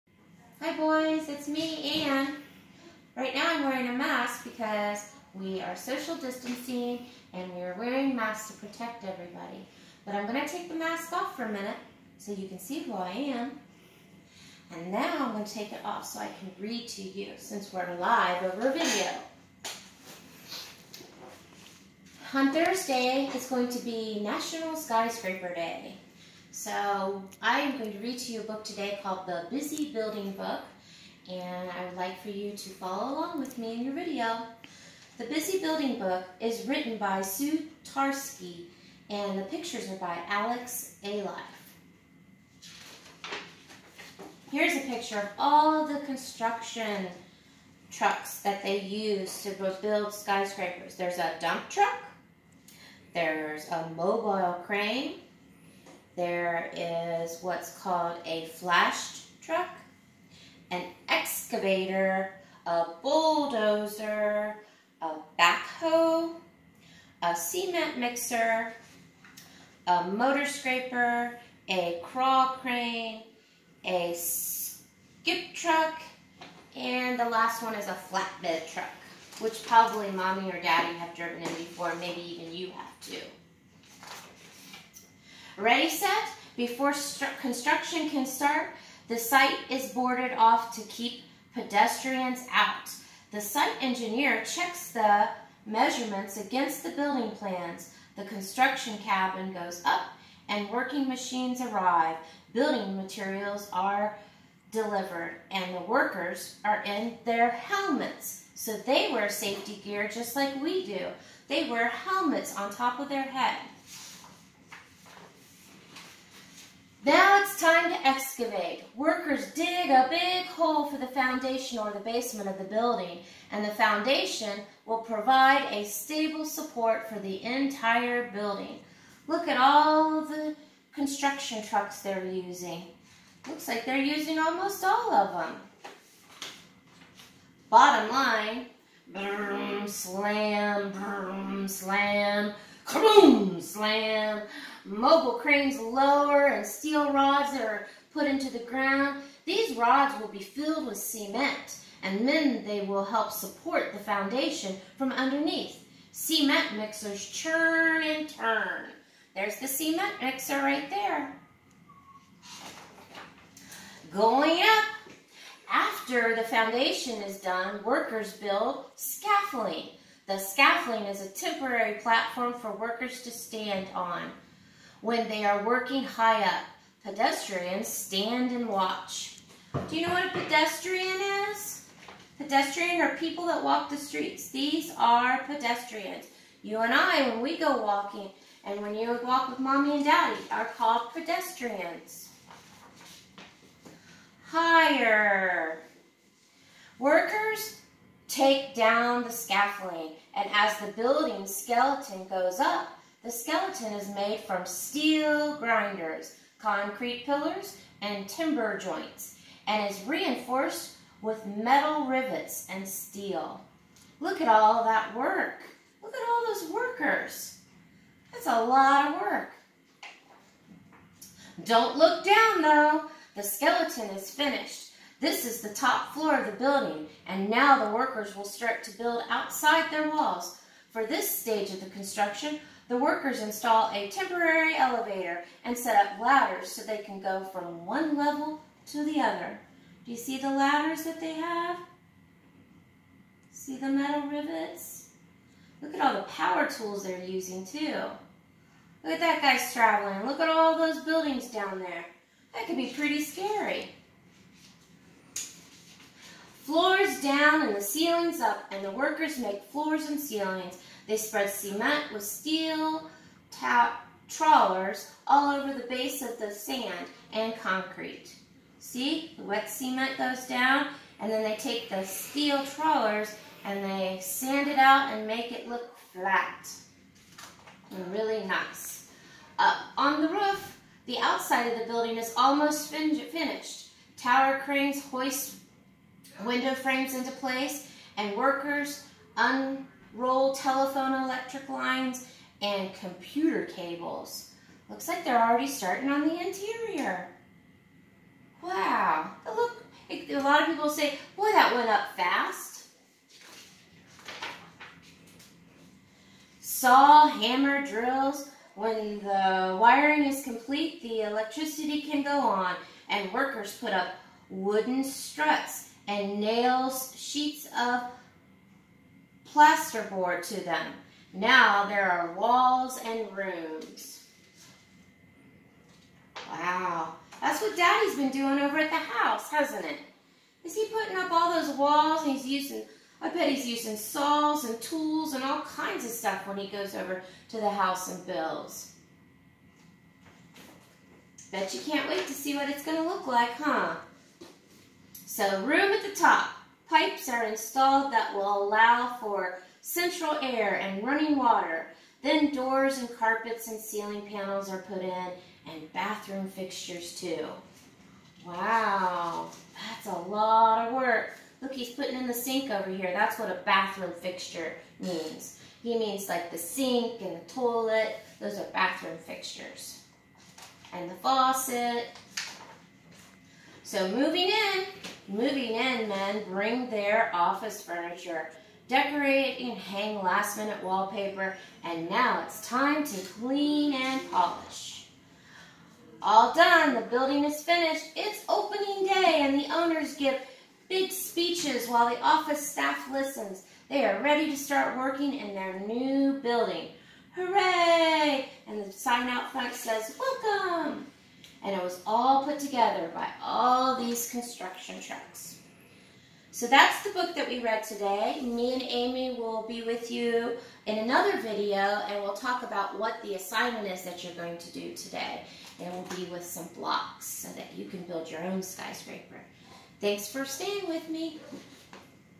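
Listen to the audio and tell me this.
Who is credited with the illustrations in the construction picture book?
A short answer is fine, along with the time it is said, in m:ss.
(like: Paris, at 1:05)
Alex Ayliffe, at 0:40.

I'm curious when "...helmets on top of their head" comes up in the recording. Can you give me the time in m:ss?
1:51.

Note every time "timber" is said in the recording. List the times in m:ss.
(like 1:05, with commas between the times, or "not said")
3:28.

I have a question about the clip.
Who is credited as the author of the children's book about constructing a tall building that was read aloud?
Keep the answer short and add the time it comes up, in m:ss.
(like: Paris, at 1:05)
Sue Tarsky, at 0:37.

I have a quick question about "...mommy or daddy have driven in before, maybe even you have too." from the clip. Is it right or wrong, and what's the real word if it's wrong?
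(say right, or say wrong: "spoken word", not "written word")
right.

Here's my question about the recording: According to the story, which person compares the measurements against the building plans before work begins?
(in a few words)
site engineer.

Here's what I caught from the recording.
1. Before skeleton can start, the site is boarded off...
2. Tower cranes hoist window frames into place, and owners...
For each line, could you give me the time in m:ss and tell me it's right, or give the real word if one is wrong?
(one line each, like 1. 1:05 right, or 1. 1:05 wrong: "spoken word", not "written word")
1. 1:26 wrong: "construction", not "skeleton"
2. 4:44 wrong: "workers", not "owners".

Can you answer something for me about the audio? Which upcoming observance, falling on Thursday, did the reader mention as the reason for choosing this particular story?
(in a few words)
National Skyscraper Day.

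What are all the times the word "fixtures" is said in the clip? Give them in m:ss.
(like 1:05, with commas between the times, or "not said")
5:56, 6:04, 6:09.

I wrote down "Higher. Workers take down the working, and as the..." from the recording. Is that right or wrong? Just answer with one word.
wrong.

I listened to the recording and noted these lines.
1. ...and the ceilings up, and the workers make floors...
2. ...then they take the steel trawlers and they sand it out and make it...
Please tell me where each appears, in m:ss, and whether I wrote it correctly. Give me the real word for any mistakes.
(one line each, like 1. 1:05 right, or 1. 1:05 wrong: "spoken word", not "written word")
1. 4:17 right
2. 4:31 right.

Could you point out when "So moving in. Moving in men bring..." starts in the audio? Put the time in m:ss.
6:13.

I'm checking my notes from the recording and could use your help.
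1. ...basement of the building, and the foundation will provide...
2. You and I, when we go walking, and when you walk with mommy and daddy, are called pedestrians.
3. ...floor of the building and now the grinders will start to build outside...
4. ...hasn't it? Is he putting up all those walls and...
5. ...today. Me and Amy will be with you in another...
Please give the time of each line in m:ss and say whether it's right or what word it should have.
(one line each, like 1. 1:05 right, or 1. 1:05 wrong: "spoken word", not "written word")
1. 2:01 right
2. 3:06 right
3. 3:46 wrong: "workers", not "grinders"
4. 5:29 right
5. 6:47 right.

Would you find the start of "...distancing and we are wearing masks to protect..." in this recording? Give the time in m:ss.
0:06.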